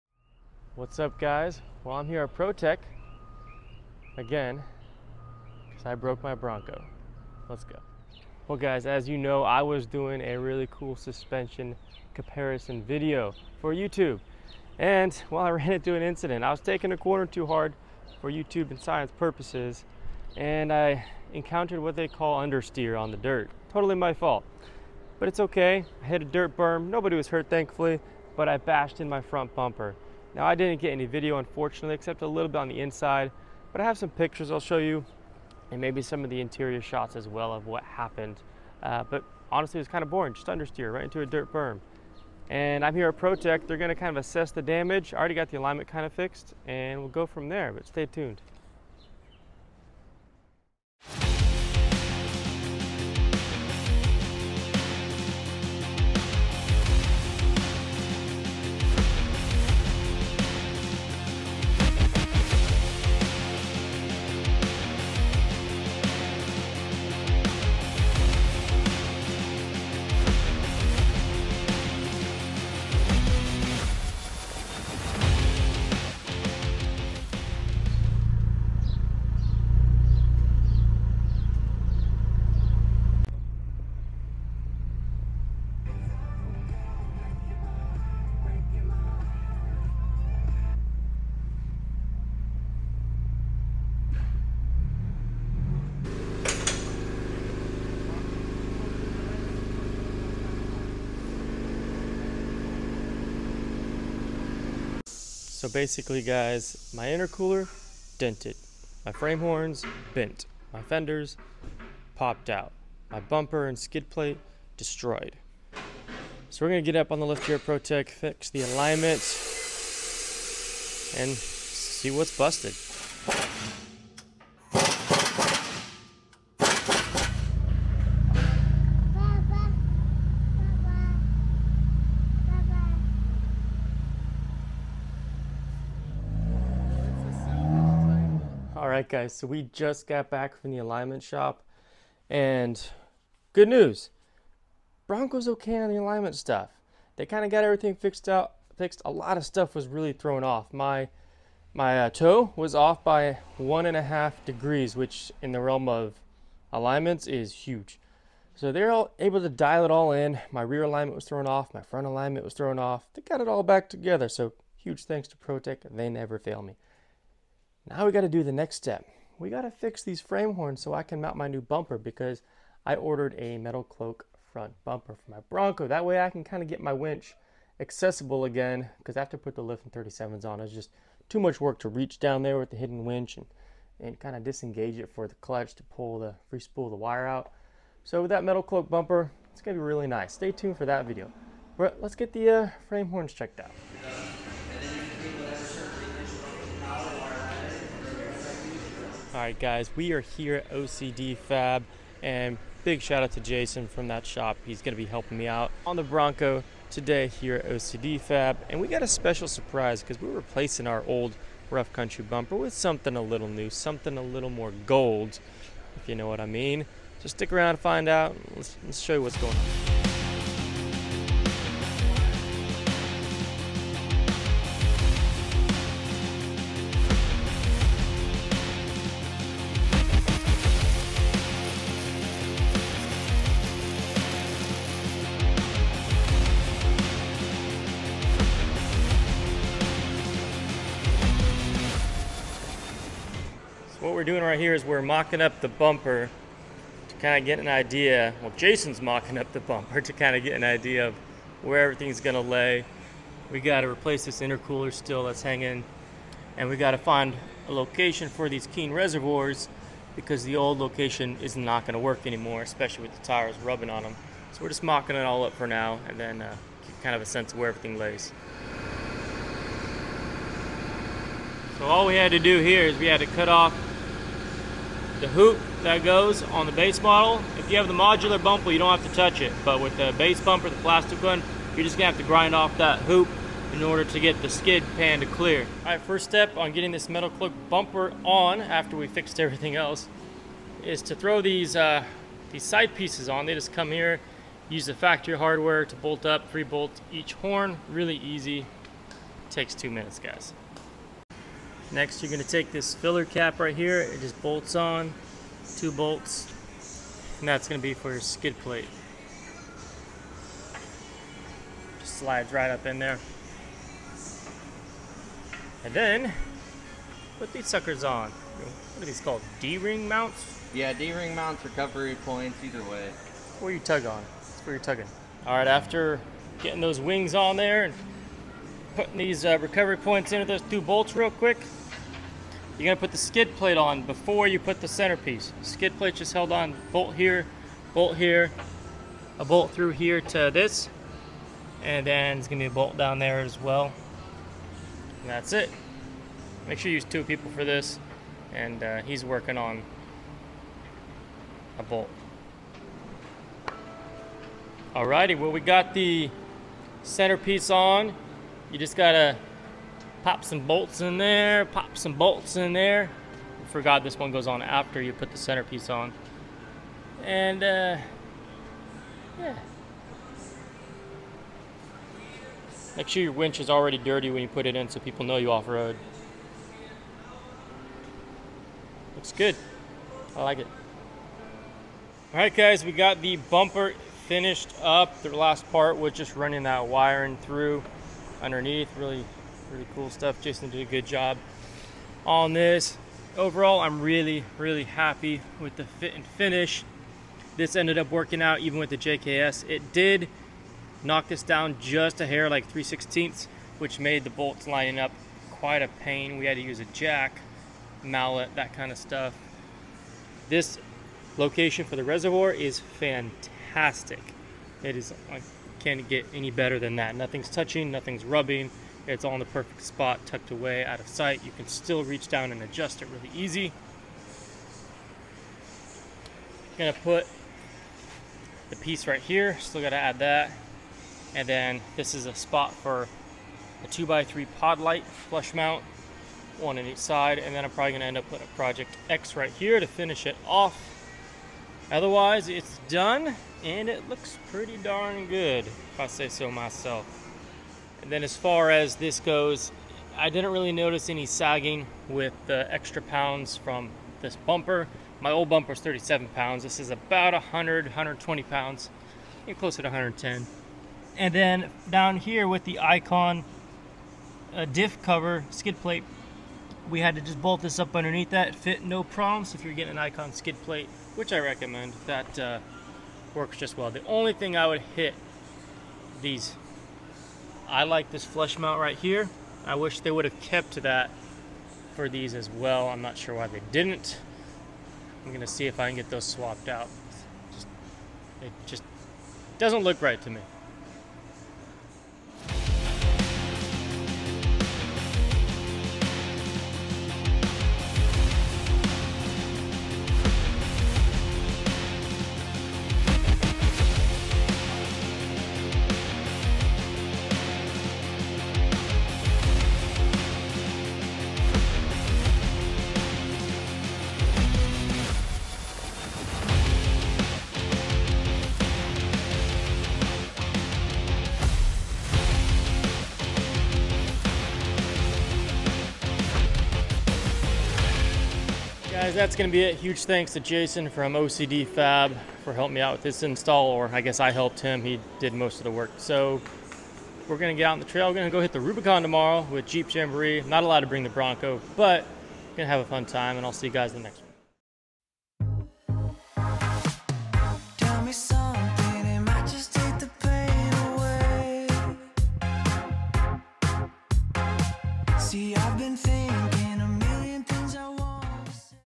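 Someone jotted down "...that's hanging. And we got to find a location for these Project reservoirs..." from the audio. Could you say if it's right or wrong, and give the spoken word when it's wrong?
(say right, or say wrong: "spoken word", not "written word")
wrong: "King", not "Project".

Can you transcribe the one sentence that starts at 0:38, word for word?
Uh, but honestly, it was kind of boring, just understeer right into a dirt berm.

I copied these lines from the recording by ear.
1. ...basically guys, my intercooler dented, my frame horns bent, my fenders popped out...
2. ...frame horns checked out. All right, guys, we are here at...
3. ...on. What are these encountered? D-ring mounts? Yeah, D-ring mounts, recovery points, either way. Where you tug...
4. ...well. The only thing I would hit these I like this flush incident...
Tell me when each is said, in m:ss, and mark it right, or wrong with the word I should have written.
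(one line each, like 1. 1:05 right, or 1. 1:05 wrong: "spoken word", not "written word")
1. 1:45 right
2. 3:12 right
3. 5:18 wrong: "called", not "encountered"
4. 7:53 wrong: "mount", not "incident".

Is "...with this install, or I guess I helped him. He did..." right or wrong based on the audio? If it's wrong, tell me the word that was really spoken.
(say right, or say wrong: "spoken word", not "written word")
right.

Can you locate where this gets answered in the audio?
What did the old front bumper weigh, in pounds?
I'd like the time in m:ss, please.
7:35.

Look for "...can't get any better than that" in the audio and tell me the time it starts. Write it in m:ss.
6:55.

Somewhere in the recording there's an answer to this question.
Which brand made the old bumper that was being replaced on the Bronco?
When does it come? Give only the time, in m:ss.
3:31.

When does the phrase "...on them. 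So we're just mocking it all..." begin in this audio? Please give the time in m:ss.
4:23.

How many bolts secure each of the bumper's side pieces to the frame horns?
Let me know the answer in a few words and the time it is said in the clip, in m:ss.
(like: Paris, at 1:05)
3, at 4:56.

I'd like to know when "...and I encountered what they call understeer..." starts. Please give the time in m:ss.
0:20.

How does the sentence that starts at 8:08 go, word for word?
it just doesn't look right to me.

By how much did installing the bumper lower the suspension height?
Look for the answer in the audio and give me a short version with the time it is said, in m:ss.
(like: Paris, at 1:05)
3/16, at 6:42.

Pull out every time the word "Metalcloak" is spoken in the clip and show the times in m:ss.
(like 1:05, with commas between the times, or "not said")
2:53, 3:08, 4:47.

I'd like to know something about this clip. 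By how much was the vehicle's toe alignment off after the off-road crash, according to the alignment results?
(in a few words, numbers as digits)
1.5 degrees.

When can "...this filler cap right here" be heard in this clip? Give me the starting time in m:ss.
5:02.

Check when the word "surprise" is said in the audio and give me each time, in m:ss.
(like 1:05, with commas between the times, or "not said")
3:29.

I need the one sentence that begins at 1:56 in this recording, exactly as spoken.
So we're gonna get up on the lift here ProTech, fix the alignment, and see what's busted.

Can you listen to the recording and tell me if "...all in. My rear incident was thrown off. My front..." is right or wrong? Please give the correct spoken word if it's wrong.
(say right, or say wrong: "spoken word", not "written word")
wrong: "alignment", not "incident".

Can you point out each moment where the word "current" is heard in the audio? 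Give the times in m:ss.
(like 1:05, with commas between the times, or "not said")
not said.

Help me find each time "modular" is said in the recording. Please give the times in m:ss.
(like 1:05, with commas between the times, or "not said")
4:37.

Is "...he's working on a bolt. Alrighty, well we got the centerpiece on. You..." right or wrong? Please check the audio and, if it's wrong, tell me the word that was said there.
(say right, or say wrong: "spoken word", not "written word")
right.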